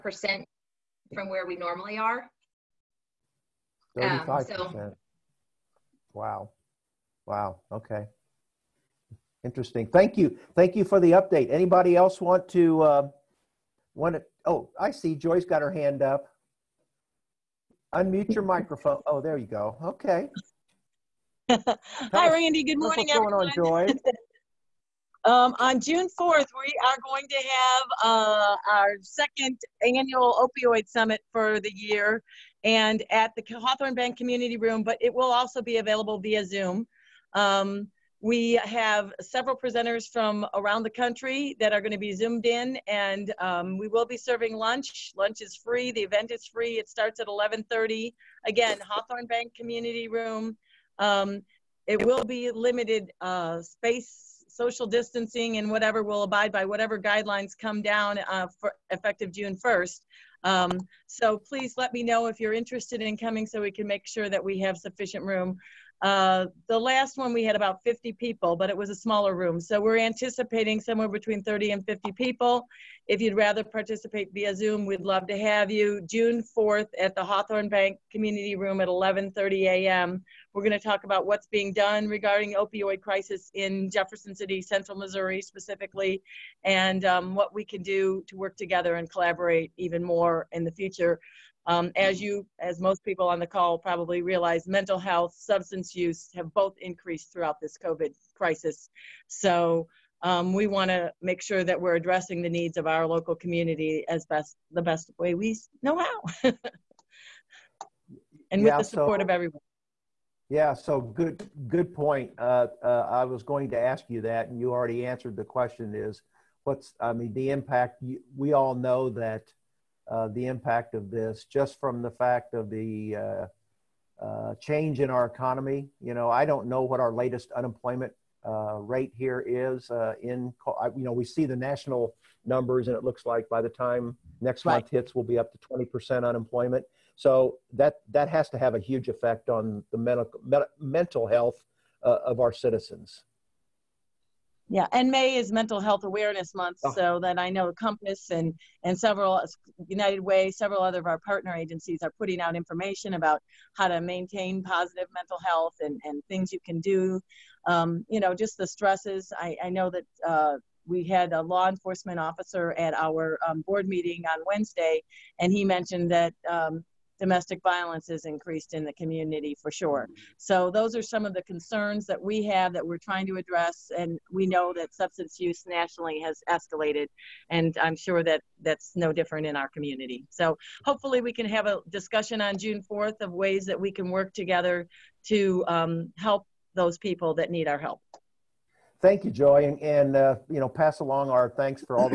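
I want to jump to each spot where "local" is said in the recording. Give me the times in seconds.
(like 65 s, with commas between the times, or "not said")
103 s.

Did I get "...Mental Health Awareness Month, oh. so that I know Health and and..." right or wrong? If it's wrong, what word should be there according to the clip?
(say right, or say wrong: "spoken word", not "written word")
wrong: "Compass", not "Health".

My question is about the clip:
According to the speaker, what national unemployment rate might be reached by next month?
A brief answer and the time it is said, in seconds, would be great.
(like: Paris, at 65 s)
20%, at 135 s.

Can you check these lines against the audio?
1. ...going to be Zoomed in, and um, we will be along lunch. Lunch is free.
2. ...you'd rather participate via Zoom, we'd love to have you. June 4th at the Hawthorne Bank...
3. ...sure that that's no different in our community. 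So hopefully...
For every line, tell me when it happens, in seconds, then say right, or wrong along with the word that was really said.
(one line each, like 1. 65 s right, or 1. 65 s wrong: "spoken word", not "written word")
1. 41 s wrong: "serving", not "along"
2. 73 s right
3. 177 s right.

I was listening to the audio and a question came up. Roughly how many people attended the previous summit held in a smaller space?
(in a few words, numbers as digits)
50.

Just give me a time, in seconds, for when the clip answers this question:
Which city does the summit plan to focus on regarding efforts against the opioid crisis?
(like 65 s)
83 s.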